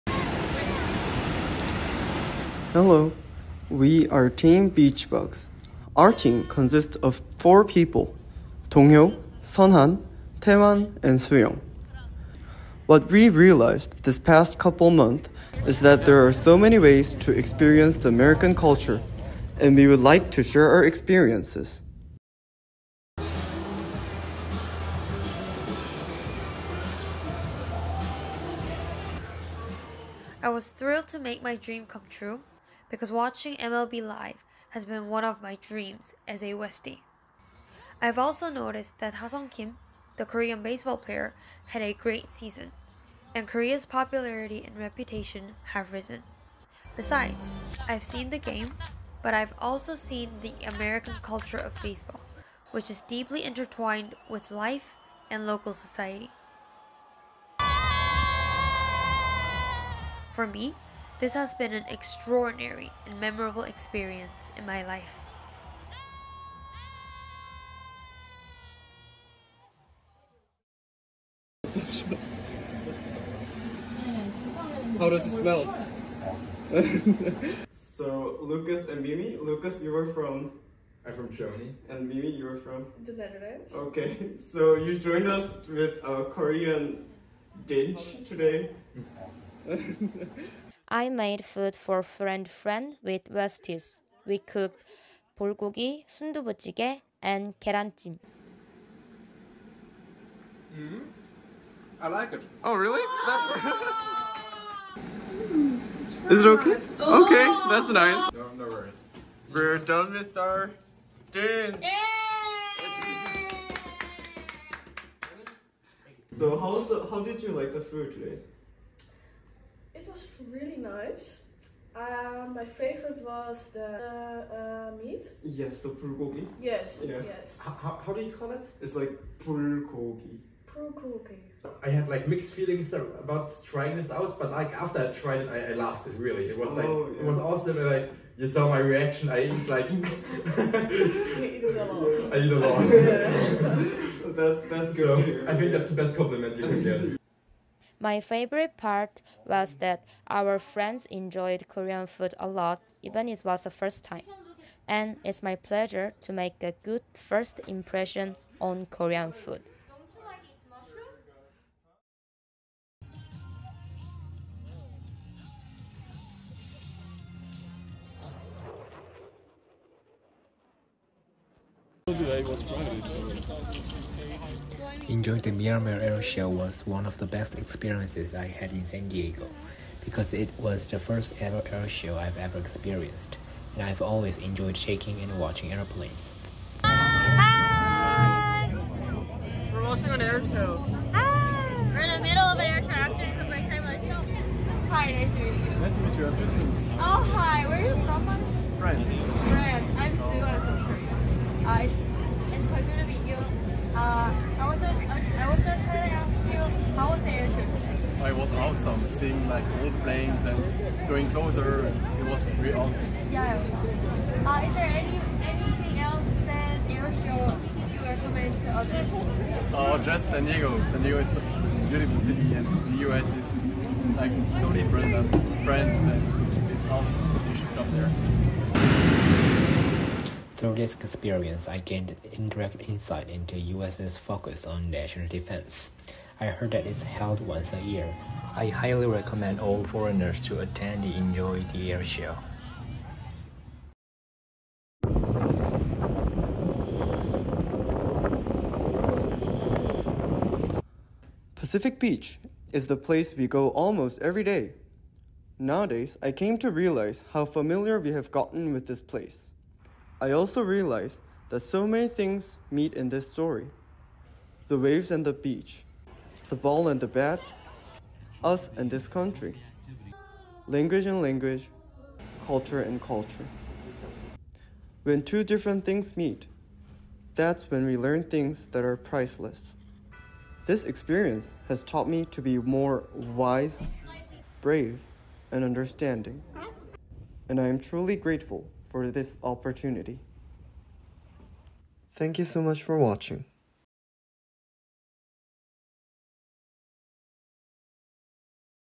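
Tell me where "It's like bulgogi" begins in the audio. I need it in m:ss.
2:08.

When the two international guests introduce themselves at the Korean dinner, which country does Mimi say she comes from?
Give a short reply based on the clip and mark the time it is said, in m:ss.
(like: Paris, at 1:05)
The Netherlands, at 1:23.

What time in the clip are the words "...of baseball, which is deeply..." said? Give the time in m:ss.
0:51.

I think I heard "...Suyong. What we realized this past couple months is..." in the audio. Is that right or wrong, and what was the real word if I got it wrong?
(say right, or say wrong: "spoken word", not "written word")
right.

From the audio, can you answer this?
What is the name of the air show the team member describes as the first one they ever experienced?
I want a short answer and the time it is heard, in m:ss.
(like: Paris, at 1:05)
Miramar Air Show, at 2:55.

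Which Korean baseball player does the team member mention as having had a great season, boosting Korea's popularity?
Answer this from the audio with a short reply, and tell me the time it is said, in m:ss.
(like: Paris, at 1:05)
Ha-Seong Kim, at 0:39.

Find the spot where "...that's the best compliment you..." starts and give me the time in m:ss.
2:25.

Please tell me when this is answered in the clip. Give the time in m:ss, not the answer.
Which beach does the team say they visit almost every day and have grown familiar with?
4:11.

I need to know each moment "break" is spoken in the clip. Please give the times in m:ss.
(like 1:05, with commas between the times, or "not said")
3:13.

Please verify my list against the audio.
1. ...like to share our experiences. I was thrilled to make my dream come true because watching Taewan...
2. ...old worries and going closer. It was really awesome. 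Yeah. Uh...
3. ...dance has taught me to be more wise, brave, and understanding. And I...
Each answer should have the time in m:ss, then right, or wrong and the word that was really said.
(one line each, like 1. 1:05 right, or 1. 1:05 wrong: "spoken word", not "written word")
1. 0:19 wrong: "MLB", not "Taewan"
2. 3:29 wrong: "planes", not "worries"
3. 4:40 wrong: "experience", not "dance".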